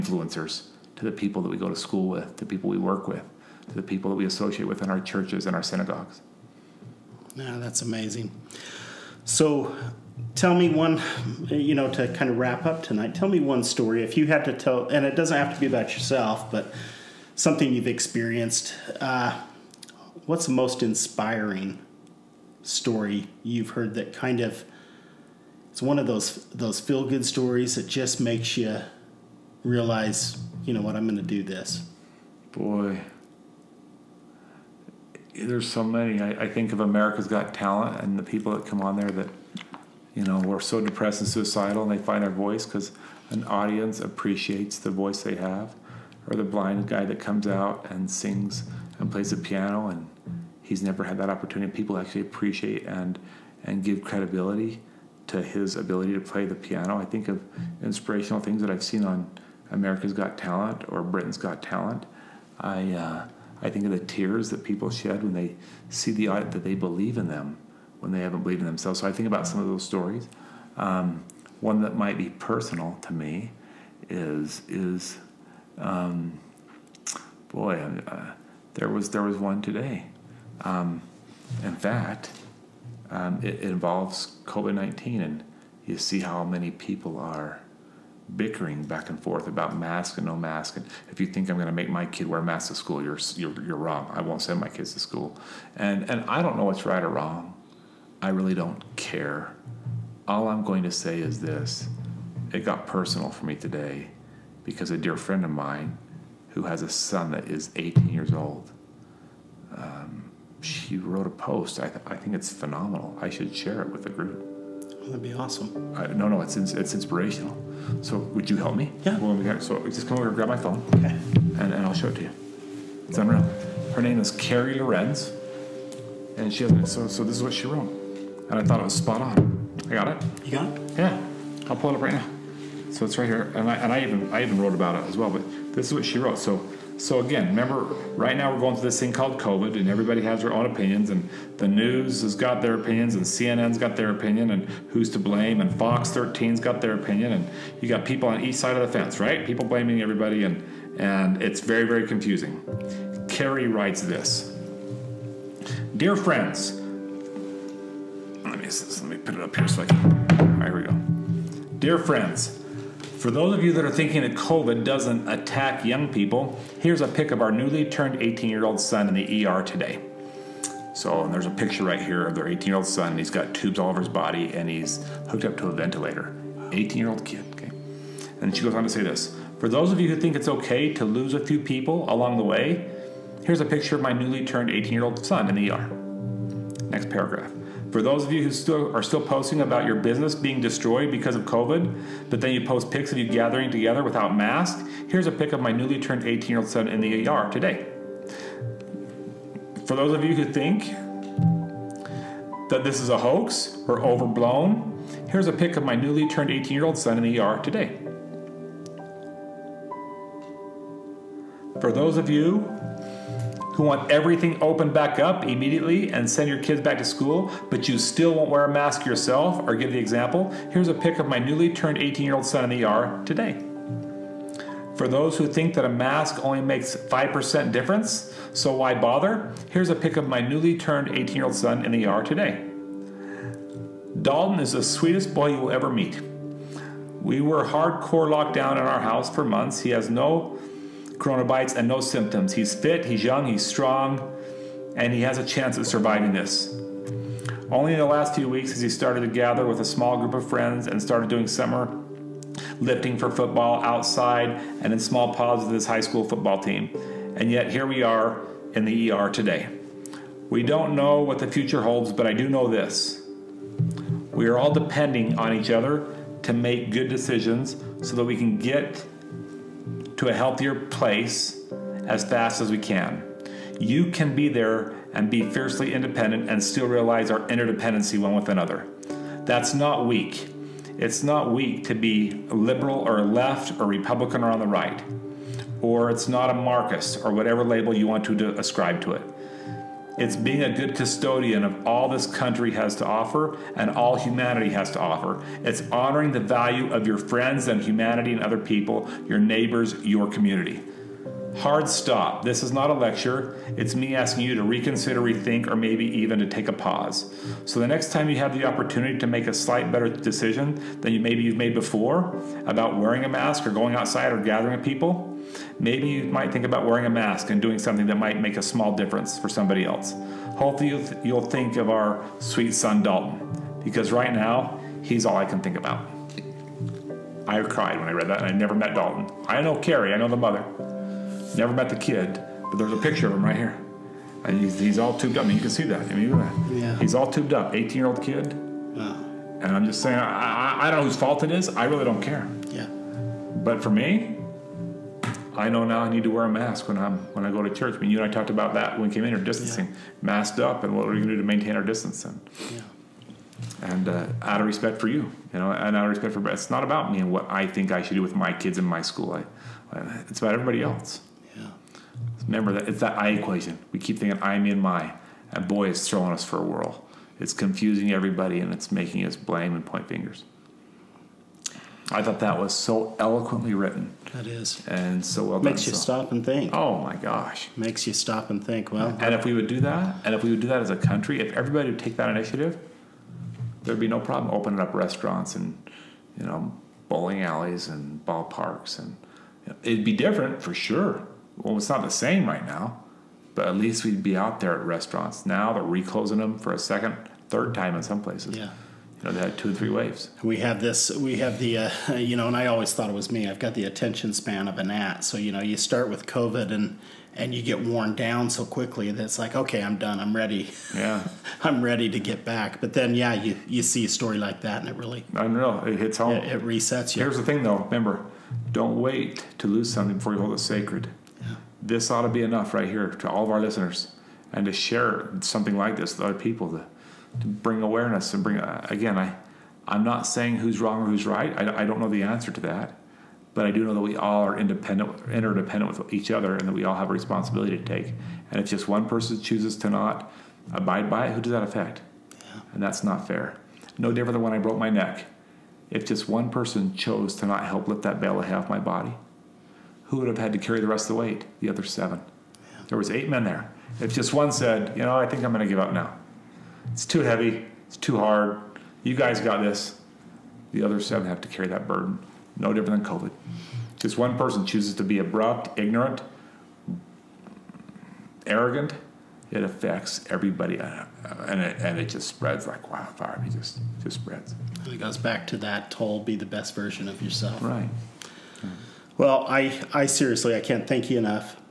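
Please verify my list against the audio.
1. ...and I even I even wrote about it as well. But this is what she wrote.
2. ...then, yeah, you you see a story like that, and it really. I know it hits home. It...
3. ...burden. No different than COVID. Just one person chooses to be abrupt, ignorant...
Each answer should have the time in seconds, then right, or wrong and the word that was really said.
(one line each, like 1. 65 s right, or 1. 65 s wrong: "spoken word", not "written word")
1. 133 s right
2. 412 s right
3. 461 s right.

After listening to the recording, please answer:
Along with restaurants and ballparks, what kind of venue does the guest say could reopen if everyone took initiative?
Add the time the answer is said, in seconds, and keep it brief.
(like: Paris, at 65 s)
Bowling alleys, at 387 s.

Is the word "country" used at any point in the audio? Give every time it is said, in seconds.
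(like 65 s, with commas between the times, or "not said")
292 s, 380 s.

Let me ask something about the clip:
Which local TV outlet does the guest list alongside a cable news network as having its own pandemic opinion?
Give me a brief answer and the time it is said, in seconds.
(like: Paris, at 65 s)
Fox 13, at 145 s.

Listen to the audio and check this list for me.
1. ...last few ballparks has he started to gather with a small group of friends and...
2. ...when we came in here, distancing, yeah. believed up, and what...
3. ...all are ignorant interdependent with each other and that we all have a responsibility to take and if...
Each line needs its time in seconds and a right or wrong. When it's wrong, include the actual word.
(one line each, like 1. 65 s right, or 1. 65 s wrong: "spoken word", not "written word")
1. 248 s wrong: "weeks", not "ballparks"
2. 348 s wrong: "masked", not "believed"
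3. 434 s wrong: "independent", not "ignorant".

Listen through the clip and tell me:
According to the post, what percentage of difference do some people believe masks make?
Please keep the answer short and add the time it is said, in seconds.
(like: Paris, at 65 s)
5%, at 226 s.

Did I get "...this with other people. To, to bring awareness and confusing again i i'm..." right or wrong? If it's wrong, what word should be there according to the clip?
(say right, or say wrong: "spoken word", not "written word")
wrong: "bring", not "confusing".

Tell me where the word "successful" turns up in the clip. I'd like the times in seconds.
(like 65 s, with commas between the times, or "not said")
not said.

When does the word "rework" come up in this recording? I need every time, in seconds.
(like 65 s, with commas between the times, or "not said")
not said.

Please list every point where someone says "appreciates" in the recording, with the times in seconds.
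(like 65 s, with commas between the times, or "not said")
43 s, 52 s.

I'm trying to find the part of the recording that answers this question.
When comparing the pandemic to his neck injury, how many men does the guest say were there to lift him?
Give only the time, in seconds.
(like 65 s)
453 s.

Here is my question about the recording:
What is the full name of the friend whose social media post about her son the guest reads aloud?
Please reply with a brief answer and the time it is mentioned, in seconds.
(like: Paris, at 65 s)
Carrie Lorenz, at 124 s.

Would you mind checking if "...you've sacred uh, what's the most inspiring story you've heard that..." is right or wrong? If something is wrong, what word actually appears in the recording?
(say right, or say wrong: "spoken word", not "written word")
wrong: "experienced", not "sacred".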